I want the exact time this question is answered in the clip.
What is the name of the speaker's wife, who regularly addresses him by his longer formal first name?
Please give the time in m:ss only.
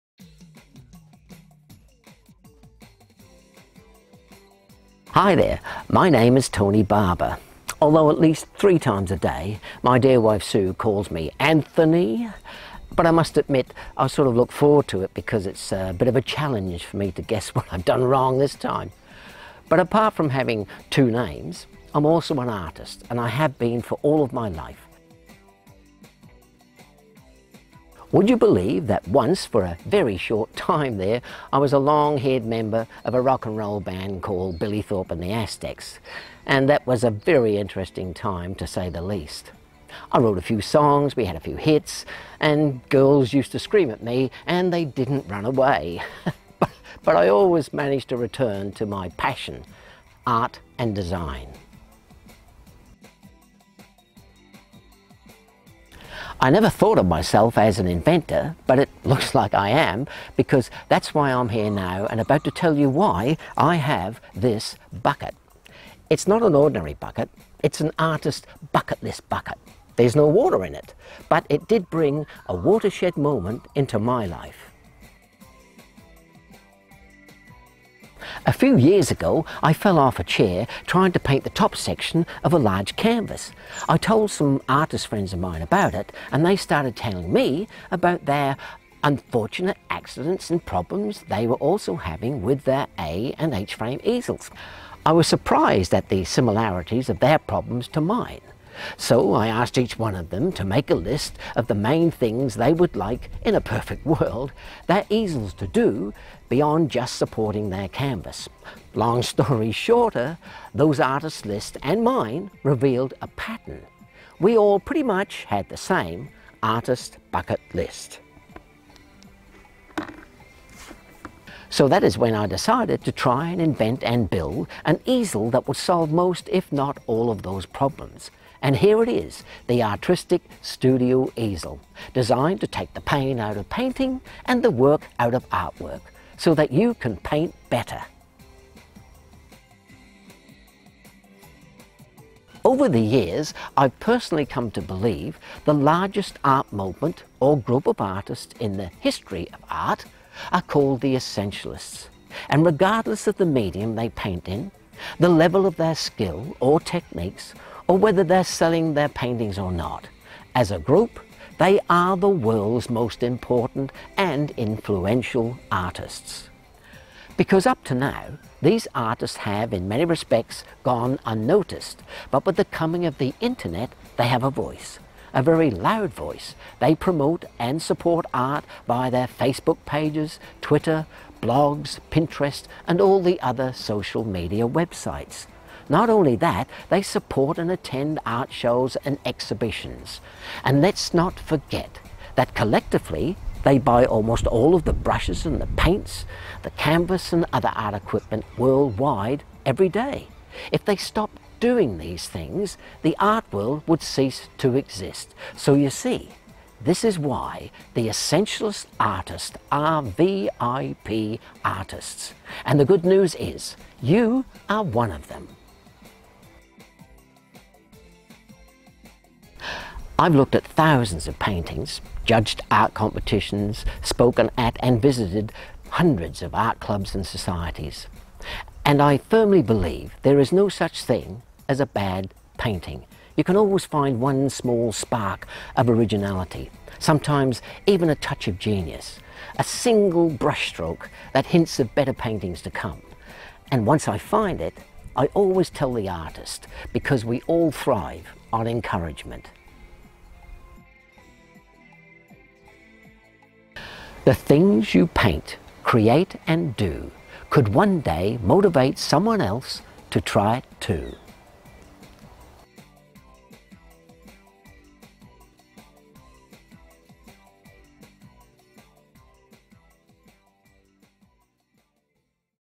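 0:10.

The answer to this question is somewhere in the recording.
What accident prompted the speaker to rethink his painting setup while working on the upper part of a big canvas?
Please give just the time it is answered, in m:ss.
1:19.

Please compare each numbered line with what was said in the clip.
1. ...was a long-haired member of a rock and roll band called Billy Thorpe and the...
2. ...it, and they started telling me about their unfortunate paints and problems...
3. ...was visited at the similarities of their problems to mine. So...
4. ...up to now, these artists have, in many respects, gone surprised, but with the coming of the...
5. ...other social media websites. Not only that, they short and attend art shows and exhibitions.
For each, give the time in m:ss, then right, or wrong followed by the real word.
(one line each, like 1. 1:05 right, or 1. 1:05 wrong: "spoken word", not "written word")
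1. 0:31 right
2. 1:25 wrong: "accidents", not "paints"
3. 1:35 wrong: "surprised", not "visited"
4. 2:47 wrong: "unnoticed", not "surprised"
5. 3:03 wrong: "support", not "short".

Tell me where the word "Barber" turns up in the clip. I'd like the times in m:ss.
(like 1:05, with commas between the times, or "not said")
0:06.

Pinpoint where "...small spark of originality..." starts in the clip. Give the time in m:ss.
3:54.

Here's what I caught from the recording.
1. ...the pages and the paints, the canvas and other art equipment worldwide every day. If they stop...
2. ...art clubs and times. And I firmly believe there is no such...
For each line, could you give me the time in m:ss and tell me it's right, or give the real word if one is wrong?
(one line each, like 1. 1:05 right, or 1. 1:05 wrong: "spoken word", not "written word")
1. 3:14 wrong: "brushes", not "pages"
2. 3:46 wrong: "societies", not "times".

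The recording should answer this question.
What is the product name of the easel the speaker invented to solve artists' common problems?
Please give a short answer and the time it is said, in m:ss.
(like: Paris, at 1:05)
Artristic Studio Easel, at 2:09.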